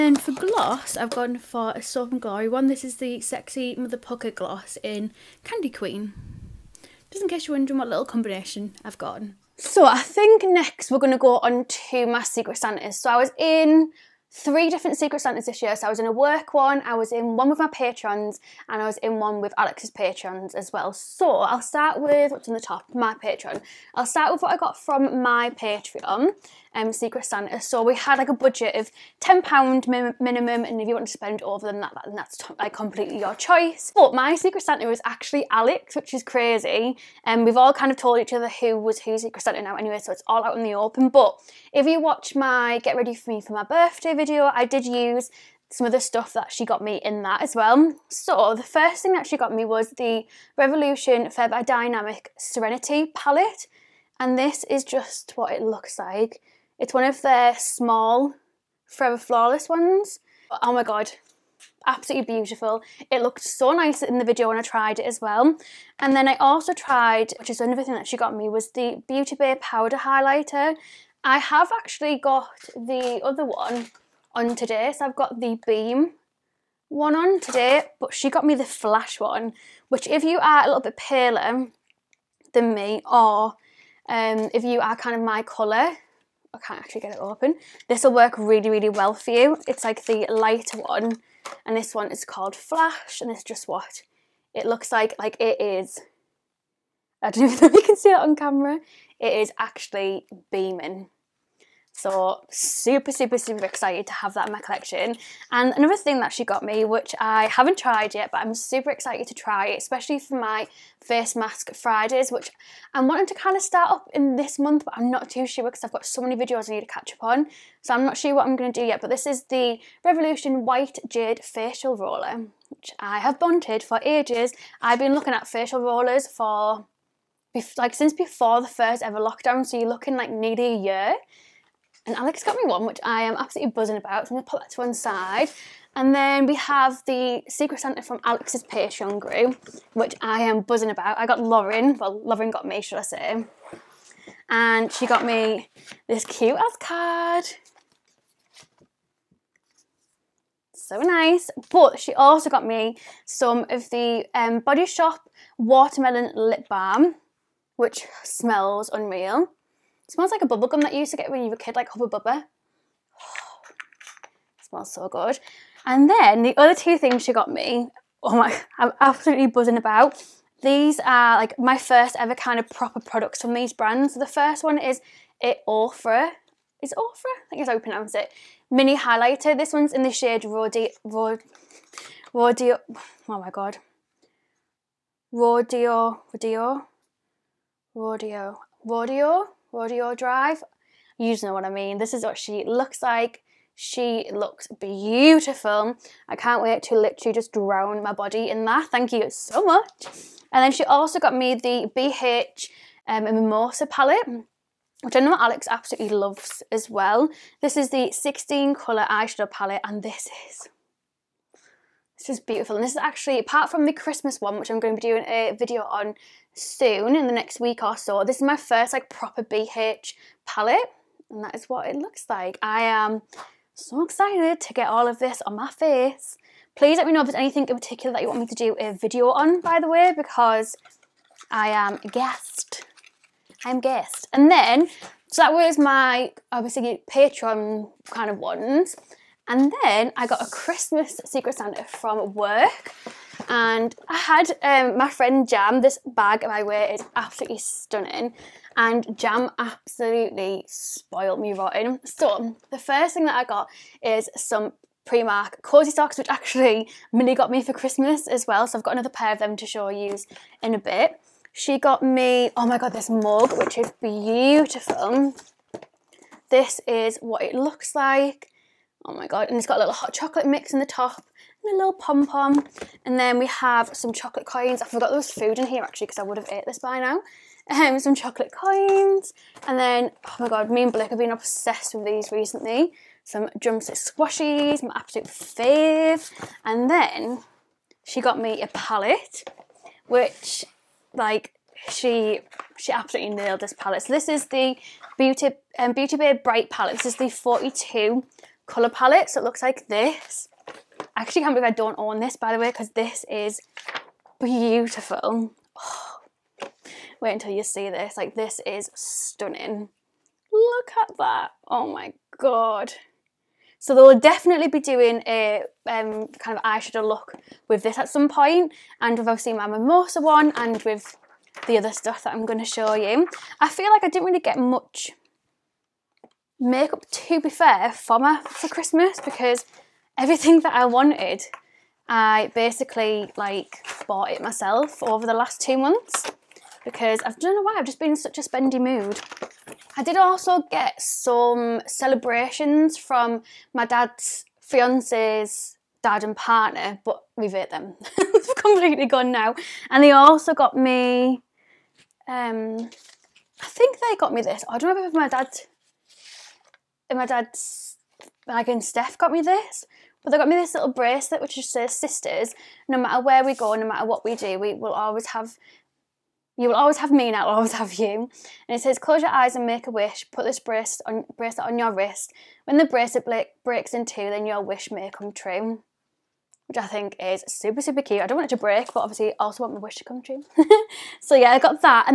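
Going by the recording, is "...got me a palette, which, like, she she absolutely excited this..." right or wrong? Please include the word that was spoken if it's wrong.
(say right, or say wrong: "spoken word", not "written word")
wrong: "nailed", not "excited".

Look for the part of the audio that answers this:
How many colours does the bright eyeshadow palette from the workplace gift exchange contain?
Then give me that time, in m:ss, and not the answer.
4:57.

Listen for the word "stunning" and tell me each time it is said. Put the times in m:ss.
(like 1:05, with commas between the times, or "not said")
4:07, 5:08.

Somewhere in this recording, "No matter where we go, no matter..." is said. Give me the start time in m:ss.
6:02.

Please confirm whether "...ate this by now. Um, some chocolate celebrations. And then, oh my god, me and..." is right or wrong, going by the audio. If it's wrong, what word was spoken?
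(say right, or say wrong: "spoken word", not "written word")
wrong: "coins", not "celebrations".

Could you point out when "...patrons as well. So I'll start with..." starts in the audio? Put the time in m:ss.
0:19.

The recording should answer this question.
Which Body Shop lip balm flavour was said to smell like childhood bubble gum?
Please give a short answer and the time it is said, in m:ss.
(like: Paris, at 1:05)
Watermelon, at 2:35.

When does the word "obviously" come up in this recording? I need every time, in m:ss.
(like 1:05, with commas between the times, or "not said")
3:56, 5:19, 6:18.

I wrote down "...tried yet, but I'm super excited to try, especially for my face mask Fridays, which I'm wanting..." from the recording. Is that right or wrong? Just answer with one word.
right.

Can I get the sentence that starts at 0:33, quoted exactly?
But my Secret Santa was actually Alex, which is crazy.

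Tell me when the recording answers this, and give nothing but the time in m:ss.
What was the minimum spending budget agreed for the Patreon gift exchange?
0:29.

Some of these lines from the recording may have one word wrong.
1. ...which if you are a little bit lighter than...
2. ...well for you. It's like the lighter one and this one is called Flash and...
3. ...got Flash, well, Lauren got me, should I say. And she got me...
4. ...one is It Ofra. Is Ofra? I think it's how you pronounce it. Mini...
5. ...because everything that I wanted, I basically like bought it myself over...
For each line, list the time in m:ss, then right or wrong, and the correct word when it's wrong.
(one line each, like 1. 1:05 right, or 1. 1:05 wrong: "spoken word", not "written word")
1. 1:19 wrong: "paler", not "lighter"
2. 1:28 right
3. 2:21 wrong: "Lauren", not "Flash"
4. 2:54 right
5. 5:29 right.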